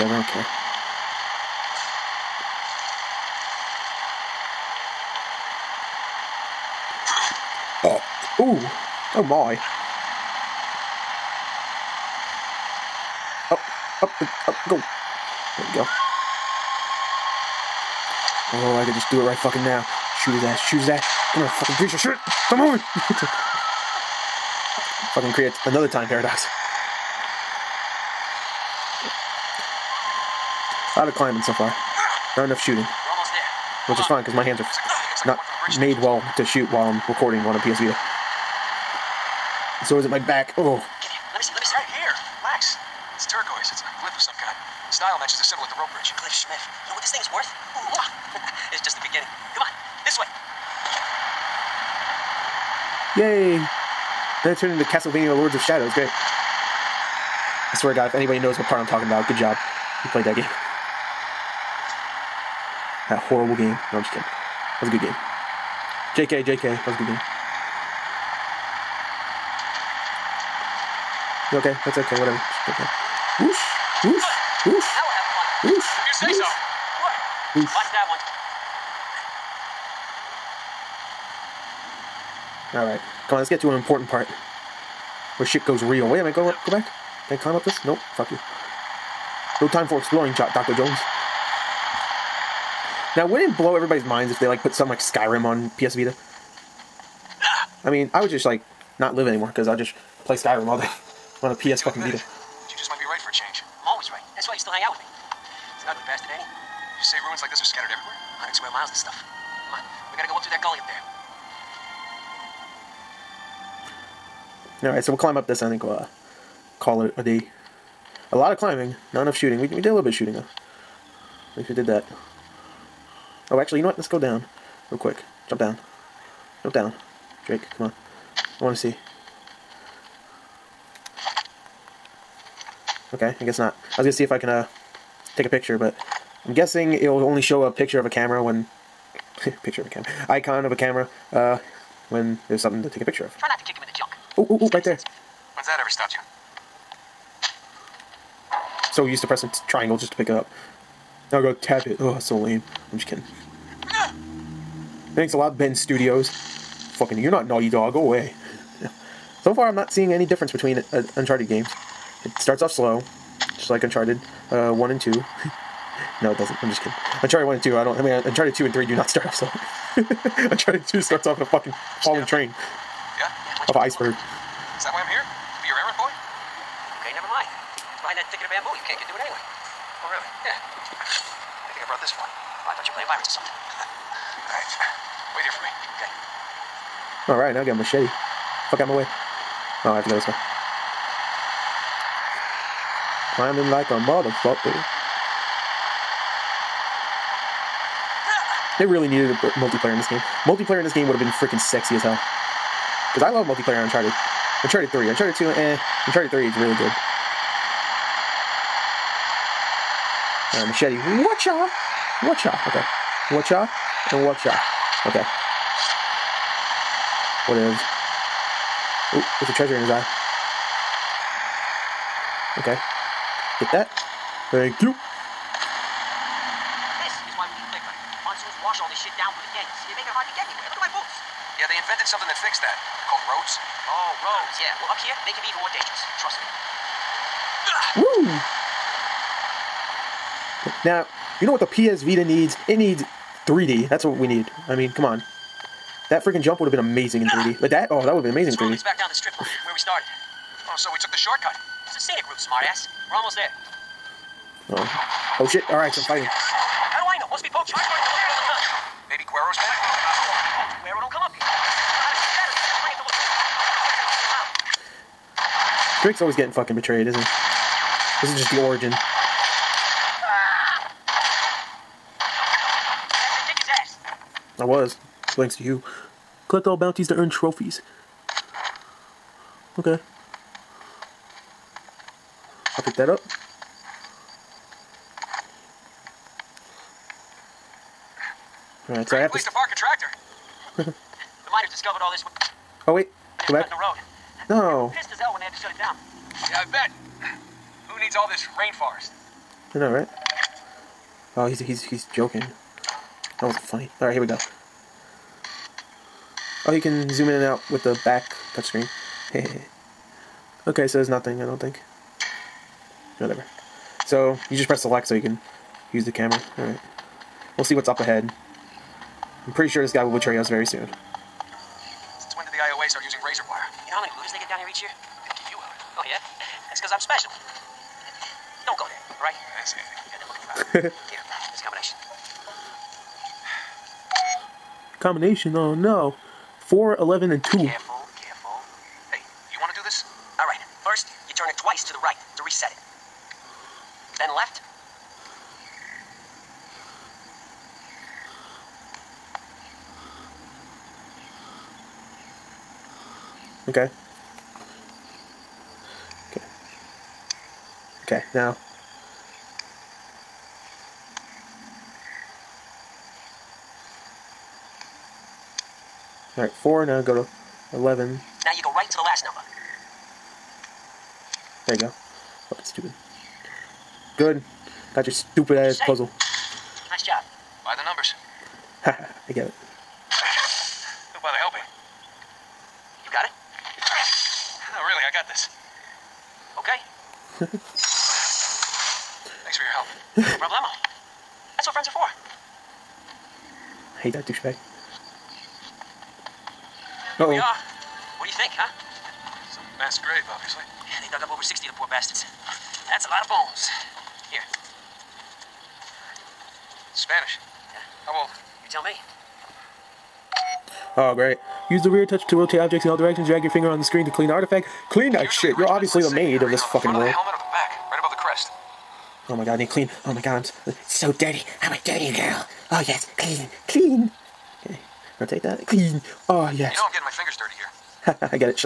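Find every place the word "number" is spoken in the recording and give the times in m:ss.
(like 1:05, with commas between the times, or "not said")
6:09, 6:17.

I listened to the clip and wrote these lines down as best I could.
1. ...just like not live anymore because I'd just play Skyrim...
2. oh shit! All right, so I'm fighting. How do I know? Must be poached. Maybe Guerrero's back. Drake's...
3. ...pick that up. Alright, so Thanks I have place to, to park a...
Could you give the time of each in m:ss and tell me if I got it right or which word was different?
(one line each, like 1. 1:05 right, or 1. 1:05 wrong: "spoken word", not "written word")
1. 1:38 right
2. 4:15 right
3. 4:42 wrong: "Great", not "Thanks".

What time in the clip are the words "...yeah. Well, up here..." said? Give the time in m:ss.
3:54.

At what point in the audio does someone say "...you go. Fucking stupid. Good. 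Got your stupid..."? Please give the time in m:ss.
6:11.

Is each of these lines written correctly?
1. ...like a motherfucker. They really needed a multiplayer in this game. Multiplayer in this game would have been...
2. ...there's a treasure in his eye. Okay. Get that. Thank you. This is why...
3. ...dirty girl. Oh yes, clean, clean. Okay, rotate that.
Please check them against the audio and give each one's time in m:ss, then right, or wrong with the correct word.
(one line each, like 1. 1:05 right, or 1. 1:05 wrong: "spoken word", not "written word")
1. 3:13 right
2. 3:39 right
3. 7:01 right.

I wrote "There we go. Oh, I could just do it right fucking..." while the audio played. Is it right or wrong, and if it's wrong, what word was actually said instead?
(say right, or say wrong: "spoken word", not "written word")
right.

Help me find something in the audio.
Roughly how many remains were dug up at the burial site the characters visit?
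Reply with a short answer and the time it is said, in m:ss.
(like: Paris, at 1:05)
60, at 6:41.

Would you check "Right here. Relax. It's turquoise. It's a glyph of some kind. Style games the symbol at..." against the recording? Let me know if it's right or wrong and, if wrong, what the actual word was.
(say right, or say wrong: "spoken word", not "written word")
wrong: "matches", not "games".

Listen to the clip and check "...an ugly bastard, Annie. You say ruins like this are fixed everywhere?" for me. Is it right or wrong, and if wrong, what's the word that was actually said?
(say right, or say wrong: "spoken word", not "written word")
wrong: "scattered", not "fixed".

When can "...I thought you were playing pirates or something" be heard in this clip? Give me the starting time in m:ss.
3:02.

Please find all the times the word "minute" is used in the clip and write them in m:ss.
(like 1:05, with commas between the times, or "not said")
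1:26.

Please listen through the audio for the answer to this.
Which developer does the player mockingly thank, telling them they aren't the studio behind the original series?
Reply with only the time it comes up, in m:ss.
2:35.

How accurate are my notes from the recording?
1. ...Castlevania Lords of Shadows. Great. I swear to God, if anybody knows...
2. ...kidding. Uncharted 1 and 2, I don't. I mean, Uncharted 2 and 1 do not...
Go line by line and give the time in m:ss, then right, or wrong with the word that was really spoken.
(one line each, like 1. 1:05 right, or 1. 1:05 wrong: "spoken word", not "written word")
1. 0:54 right
2. 2:46 wrong: "3", not "1".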